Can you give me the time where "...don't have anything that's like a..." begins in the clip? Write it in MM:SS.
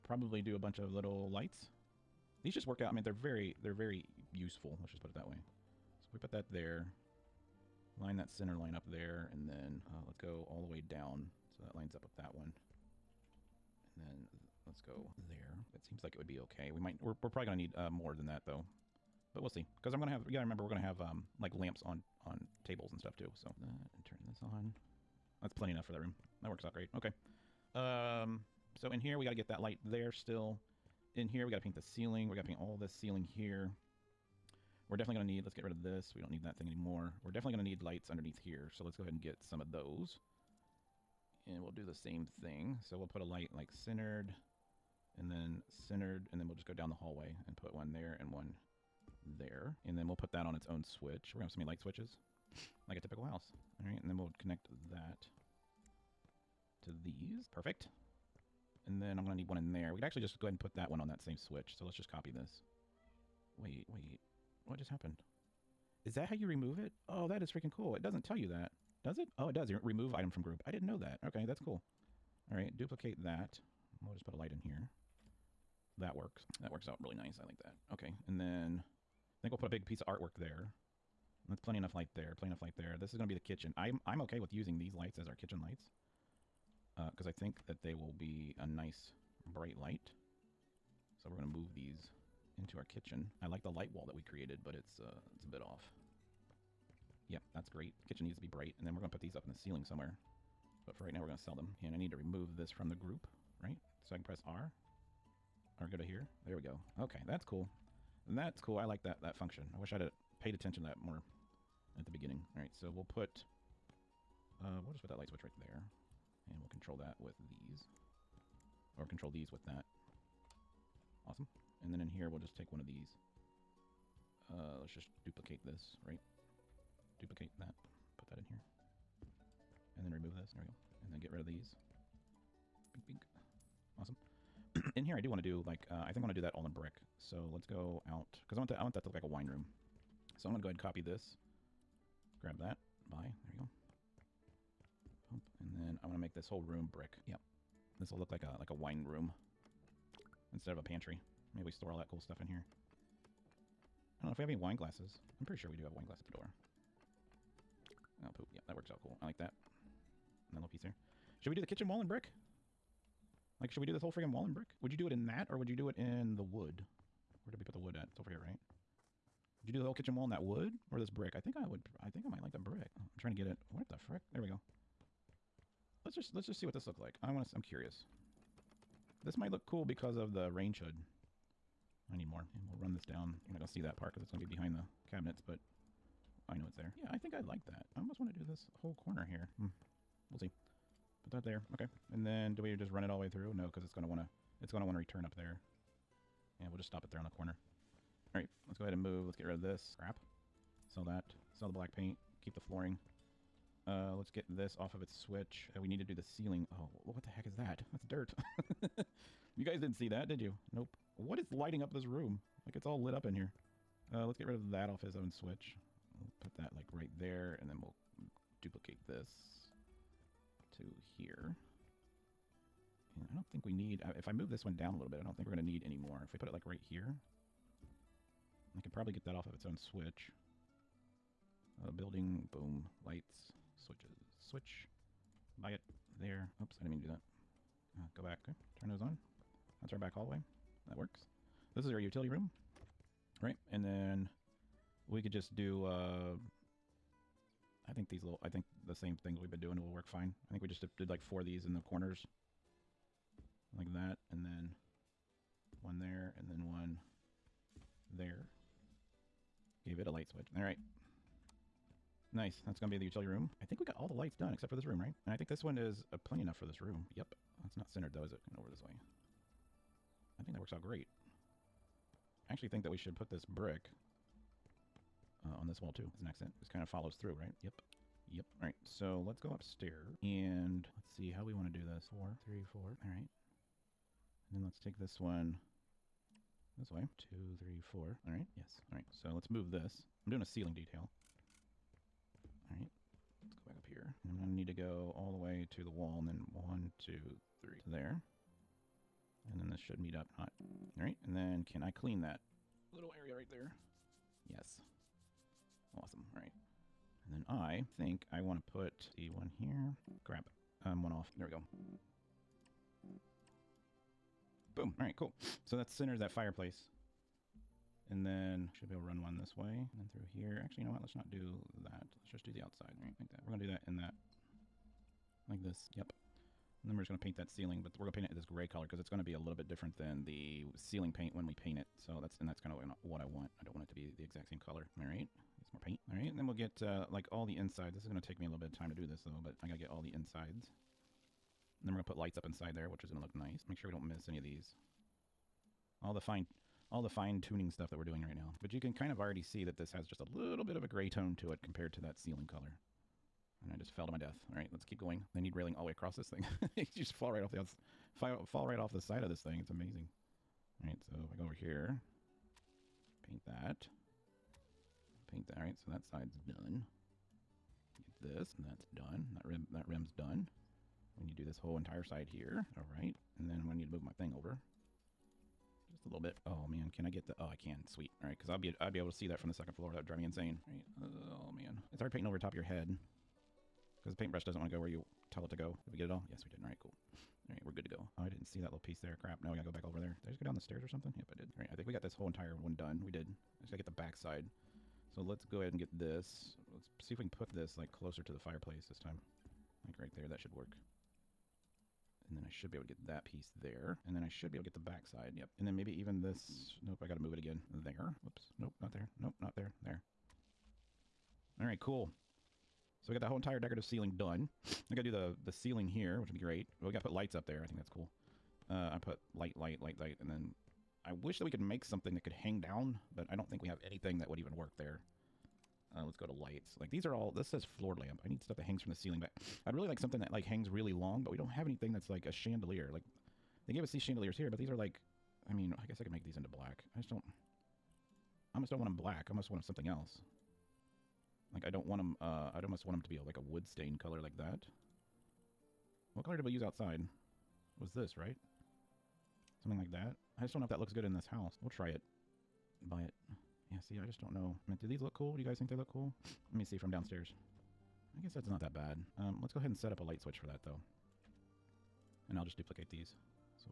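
07:11.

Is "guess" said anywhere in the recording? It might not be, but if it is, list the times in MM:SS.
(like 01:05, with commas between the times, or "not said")
07:15, 07:38.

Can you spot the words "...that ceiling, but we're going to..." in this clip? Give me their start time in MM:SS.
05:27.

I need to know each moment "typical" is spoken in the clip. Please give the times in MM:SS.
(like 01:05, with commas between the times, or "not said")
00:52.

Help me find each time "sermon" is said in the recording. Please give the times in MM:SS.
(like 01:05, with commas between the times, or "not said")
not said.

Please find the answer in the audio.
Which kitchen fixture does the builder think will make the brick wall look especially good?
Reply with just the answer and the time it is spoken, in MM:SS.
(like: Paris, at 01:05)
range hood, at 03:00.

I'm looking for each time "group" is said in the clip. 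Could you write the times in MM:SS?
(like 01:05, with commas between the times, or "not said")
01:10, 01:42.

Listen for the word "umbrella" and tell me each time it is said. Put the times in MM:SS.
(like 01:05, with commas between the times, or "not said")
not said.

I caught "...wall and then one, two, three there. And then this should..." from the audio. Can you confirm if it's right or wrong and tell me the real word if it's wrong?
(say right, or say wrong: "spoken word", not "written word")
right.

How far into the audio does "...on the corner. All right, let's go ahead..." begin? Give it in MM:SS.
03:17.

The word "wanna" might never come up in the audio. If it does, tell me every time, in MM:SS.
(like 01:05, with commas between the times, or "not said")
06:24.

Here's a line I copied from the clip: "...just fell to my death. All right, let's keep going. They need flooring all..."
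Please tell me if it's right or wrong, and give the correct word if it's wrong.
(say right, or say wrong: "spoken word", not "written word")
wrong: "railing", not "flooring".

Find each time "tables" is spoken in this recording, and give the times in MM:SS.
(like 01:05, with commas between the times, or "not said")
00:22.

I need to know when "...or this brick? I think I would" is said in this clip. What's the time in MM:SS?
02:50.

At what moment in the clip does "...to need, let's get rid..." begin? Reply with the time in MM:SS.
00:35.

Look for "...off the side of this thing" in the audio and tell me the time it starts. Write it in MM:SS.
05:58.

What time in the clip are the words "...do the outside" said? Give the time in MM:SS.
05:22.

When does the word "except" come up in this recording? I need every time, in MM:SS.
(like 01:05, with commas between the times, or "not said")
04:24.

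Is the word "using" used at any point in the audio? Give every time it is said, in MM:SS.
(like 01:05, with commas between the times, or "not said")
01:24.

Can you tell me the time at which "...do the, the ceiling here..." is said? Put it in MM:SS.
06:55.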